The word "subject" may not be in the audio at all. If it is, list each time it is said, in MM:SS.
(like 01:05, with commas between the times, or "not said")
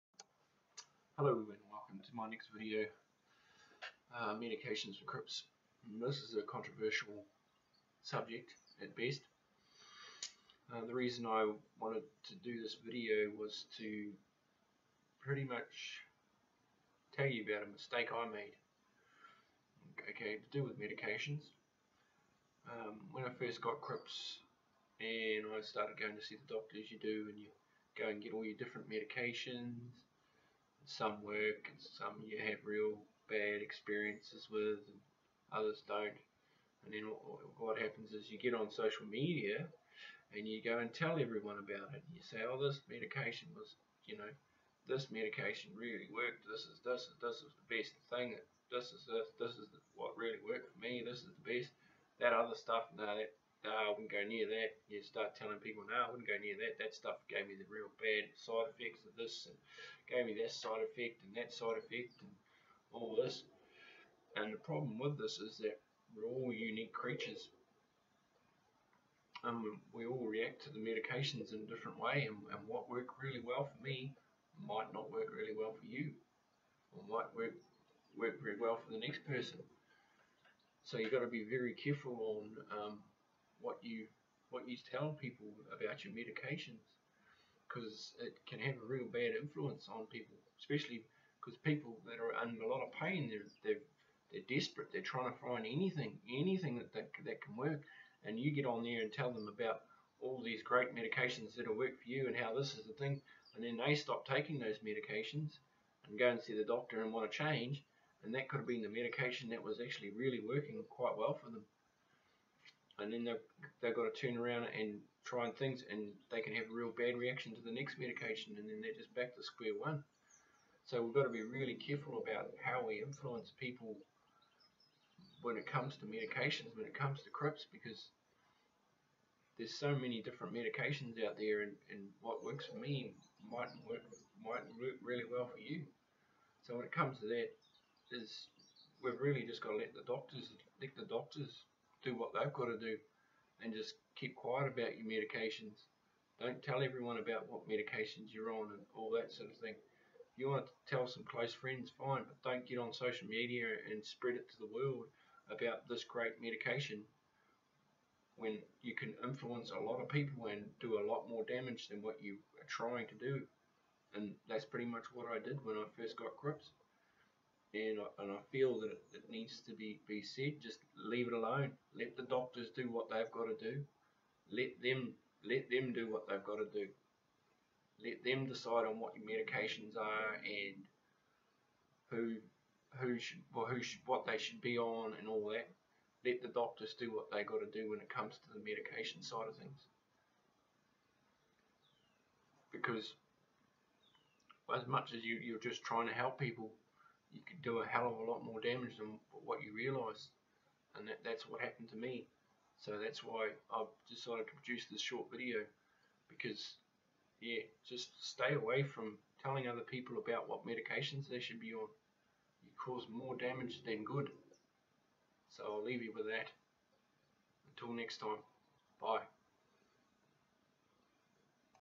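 00:08.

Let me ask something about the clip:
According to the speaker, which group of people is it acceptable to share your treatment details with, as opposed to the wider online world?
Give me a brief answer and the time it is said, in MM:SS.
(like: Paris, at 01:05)
close friends, at 02:31.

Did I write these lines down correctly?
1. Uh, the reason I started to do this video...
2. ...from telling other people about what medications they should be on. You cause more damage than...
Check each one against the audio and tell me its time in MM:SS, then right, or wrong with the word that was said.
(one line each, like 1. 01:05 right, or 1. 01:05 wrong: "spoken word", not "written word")
1. 00:10 wrong: "wanted", not "started"
2. 03:28 right.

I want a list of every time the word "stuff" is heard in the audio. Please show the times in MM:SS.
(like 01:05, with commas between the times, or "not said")
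00:52, 00:56.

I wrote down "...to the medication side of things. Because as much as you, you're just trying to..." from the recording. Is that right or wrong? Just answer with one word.
right.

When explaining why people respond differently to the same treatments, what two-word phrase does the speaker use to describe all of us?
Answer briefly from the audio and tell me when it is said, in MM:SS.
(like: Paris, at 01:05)
unique creatures, at 01:06.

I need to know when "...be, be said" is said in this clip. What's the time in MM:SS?
02:49.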